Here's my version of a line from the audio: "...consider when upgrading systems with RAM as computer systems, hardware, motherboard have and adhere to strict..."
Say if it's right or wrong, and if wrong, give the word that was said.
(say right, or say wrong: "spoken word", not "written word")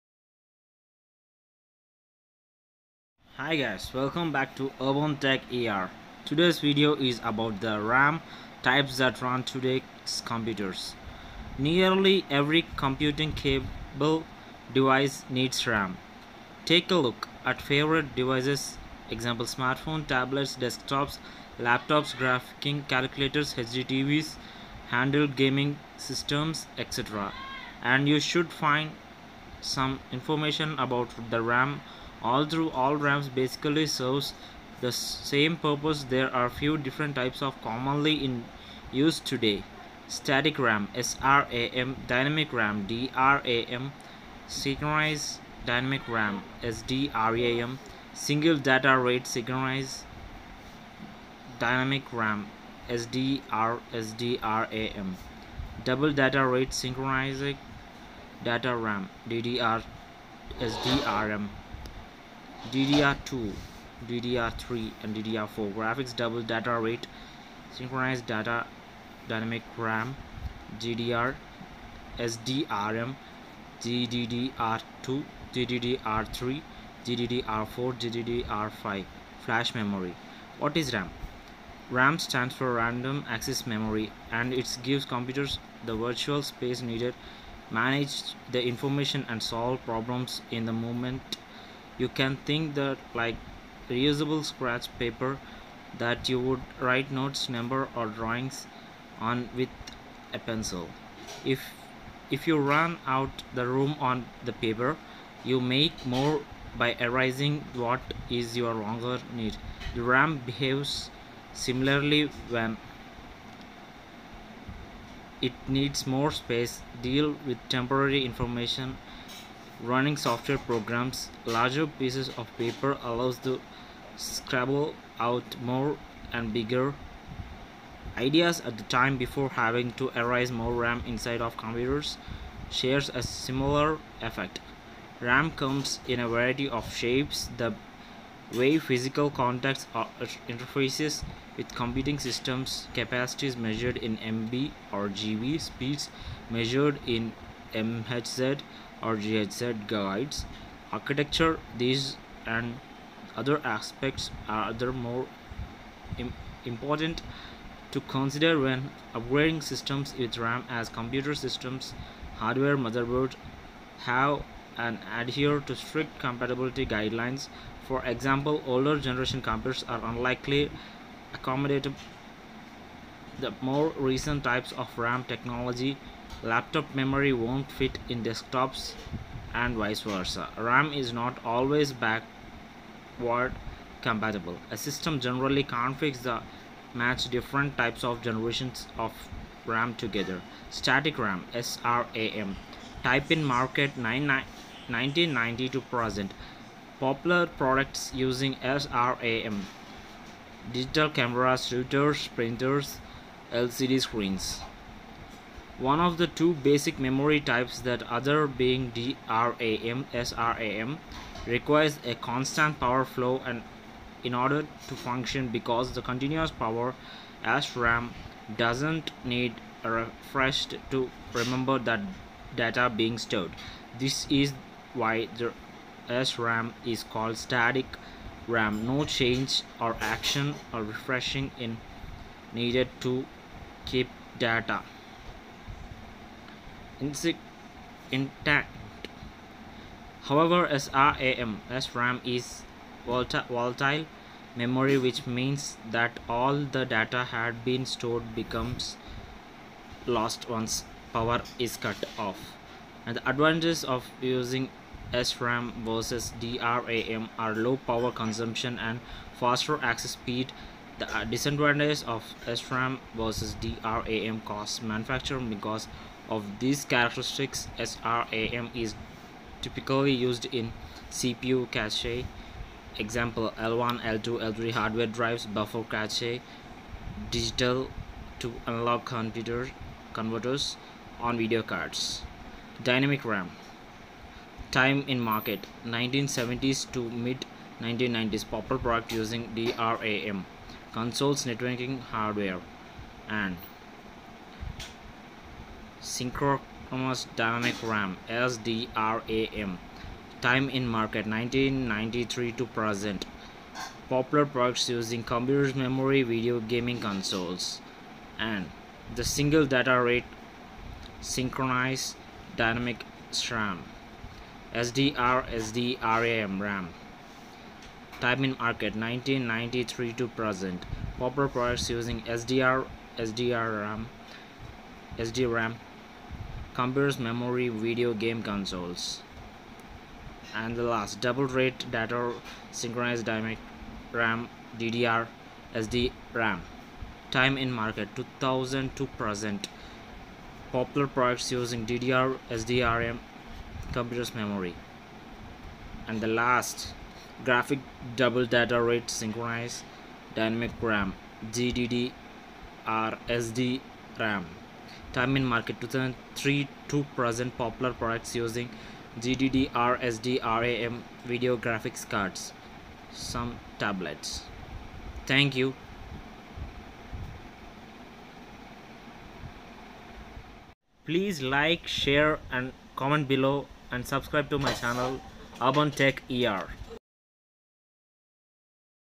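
right.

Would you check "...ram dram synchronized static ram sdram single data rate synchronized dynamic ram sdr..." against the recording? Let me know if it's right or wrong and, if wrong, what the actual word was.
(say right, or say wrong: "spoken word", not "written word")
wrong: "dynamic", not "static".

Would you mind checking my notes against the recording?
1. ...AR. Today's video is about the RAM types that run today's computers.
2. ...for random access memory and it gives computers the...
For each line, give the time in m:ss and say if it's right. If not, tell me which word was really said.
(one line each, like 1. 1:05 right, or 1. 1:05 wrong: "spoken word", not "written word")
1. 0:05 right
2. 1:22 right.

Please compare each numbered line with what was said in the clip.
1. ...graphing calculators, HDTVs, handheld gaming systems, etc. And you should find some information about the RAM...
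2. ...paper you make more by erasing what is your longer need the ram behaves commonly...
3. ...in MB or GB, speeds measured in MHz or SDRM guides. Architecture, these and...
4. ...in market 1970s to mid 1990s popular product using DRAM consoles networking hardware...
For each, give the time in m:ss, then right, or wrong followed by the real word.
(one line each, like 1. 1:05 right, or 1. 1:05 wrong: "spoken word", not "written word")
1. 0:22 right
2. 1:44 wrong: "similarly", not "commonly"
3. 2:23 wrong: "GHZ", not "SDRM"
4. 4:45 right.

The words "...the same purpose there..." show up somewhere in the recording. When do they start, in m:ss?
0:34.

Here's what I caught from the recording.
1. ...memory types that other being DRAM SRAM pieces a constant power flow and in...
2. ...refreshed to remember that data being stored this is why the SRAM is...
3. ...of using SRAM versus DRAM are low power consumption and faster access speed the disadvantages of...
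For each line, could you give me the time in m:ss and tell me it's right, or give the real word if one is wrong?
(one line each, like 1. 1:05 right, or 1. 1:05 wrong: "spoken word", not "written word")
1. 3:26 wrong: "requires", not "pieces"
2. 3:39 right
3. 4:13 right.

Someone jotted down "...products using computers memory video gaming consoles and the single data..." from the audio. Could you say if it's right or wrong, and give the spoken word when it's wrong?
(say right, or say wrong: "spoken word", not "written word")
right.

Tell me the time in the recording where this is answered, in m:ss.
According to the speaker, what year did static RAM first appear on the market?
3:13.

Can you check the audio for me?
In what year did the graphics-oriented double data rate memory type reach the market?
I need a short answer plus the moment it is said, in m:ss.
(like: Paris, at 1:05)
2003, at 5:55.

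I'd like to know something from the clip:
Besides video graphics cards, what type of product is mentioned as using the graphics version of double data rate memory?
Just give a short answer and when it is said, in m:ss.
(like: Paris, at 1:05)
Some tablets, at 6:03.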